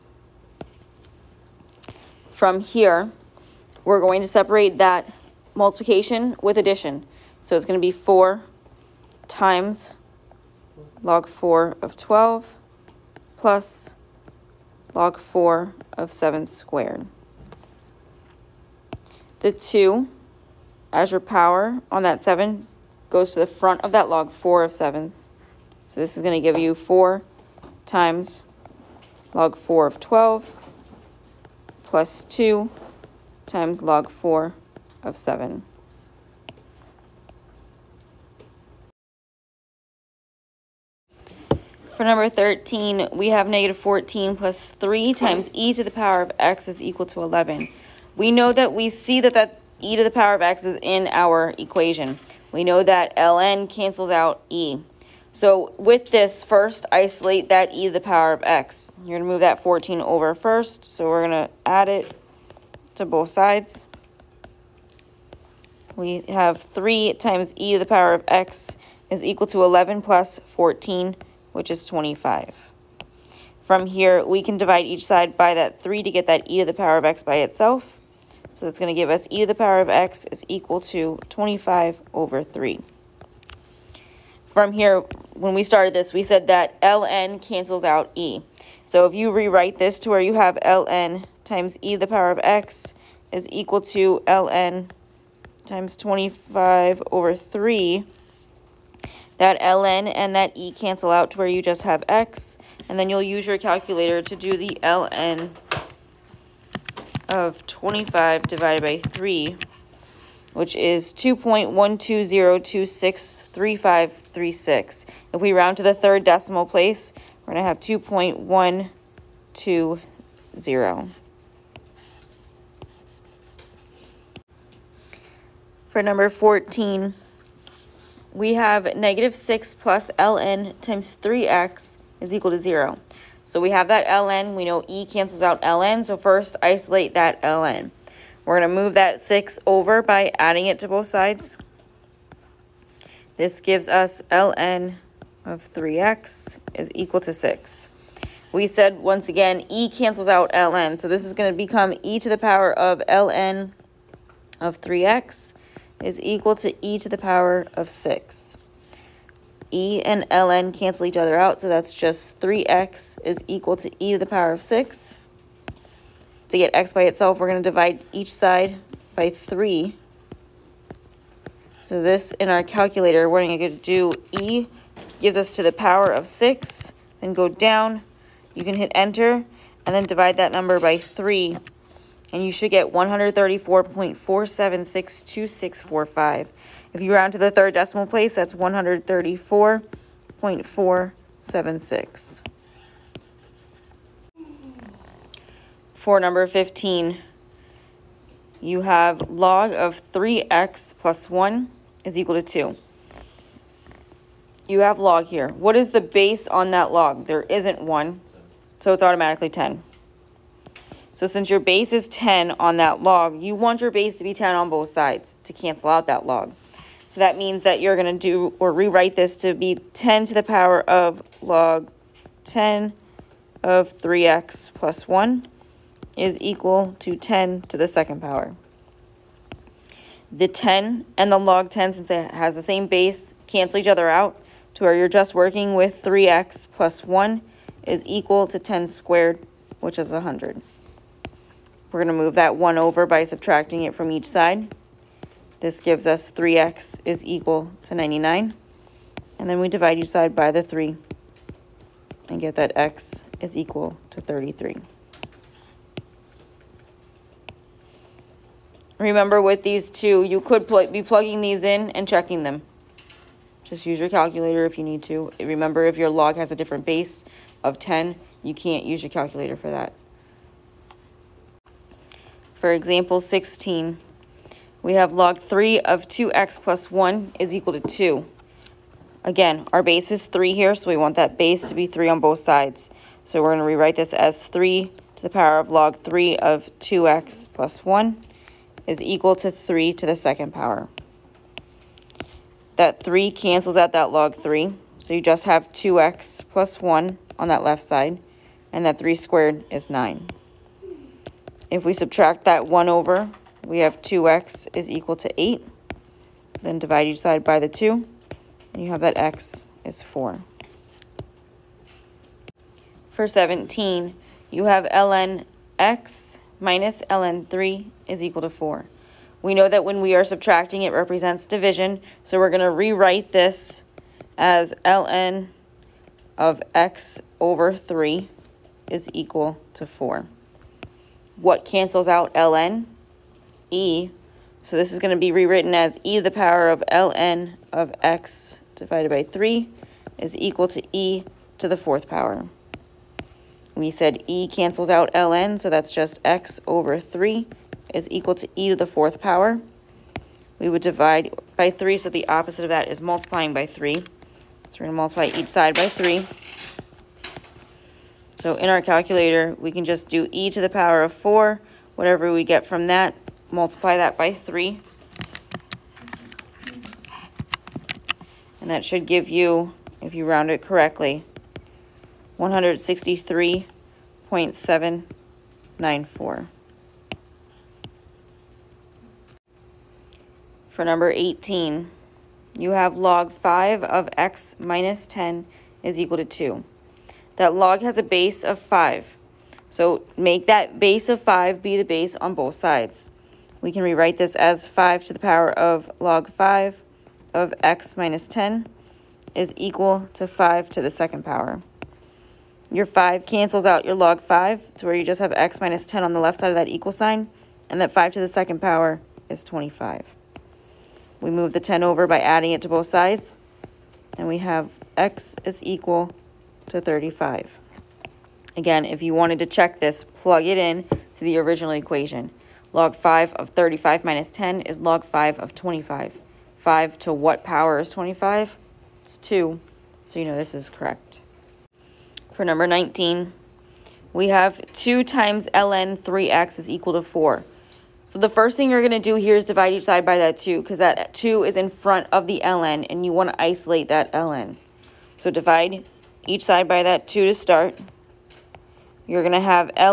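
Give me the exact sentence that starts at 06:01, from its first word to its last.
Whatever we get from that, multiply that by 3.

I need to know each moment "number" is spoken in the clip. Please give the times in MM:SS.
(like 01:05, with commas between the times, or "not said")
00:42, 02:06, 03:00, 03:16, 06:20, 07:12.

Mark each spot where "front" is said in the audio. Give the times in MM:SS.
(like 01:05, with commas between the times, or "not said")
00:23, 07:21.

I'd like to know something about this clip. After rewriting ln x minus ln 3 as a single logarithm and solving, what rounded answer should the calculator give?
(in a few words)
163.794.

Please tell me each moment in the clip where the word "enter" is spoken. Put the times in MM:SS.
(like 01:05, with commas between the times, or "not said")
02:58.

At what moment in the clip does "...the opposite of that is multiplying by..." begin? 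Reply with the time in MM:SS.
05:52.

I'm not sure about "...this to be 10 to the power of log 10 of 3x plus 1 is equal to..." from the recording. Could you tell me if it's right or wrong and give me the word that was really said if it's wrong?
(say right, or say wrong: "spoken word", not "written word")
right.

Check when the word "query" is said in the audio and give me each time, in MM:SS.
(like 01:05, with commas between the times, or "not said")
not said.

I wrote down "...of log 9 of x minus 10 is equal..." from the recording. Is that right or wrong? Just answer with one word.
wrong.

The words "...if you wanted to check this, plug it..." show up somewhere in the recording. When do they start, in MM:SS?
06:58.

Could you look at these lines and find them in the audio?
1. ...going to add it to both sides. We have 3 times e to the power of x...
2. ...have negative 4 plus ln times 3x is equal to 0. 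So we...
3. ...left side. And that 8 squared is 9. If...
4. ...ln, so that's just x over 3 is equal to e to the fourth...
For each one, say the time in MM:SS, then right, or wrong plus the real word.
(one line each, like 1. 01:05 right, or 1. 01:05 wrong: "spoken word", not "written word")
1. 01:01 right
2. 02:08 wrong: "6", not "4"
3. 04:57 wrong: "3", not "8"
4. 05:45 right.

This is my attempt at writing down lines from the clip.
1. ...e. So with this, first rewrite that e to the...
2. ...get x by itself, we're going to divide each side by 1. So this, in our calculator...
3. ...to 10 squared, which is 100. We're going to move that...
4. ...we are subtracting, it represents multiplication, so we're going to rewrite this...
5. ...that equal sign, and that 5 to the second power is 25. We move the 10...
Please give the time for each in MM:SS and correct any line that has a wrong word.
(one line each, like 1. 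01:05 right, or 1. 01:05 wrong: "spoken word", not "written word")
1. 00:54 wrong: "isolate", not "rewrite"
2. 02:46 wrong: "3", not "1"
3. 03:58 right
4. 05:20 wrong: "division", not "multiplication"
5. 06:46 right.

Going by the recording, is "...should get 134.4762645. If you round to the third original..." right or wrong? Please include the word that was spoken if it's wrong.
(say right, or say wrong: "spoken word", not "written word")
wrong: "decimal", not "original".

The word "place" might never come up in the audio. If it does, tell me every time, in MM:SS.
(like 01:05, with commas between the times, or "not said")
01:56, 03:08.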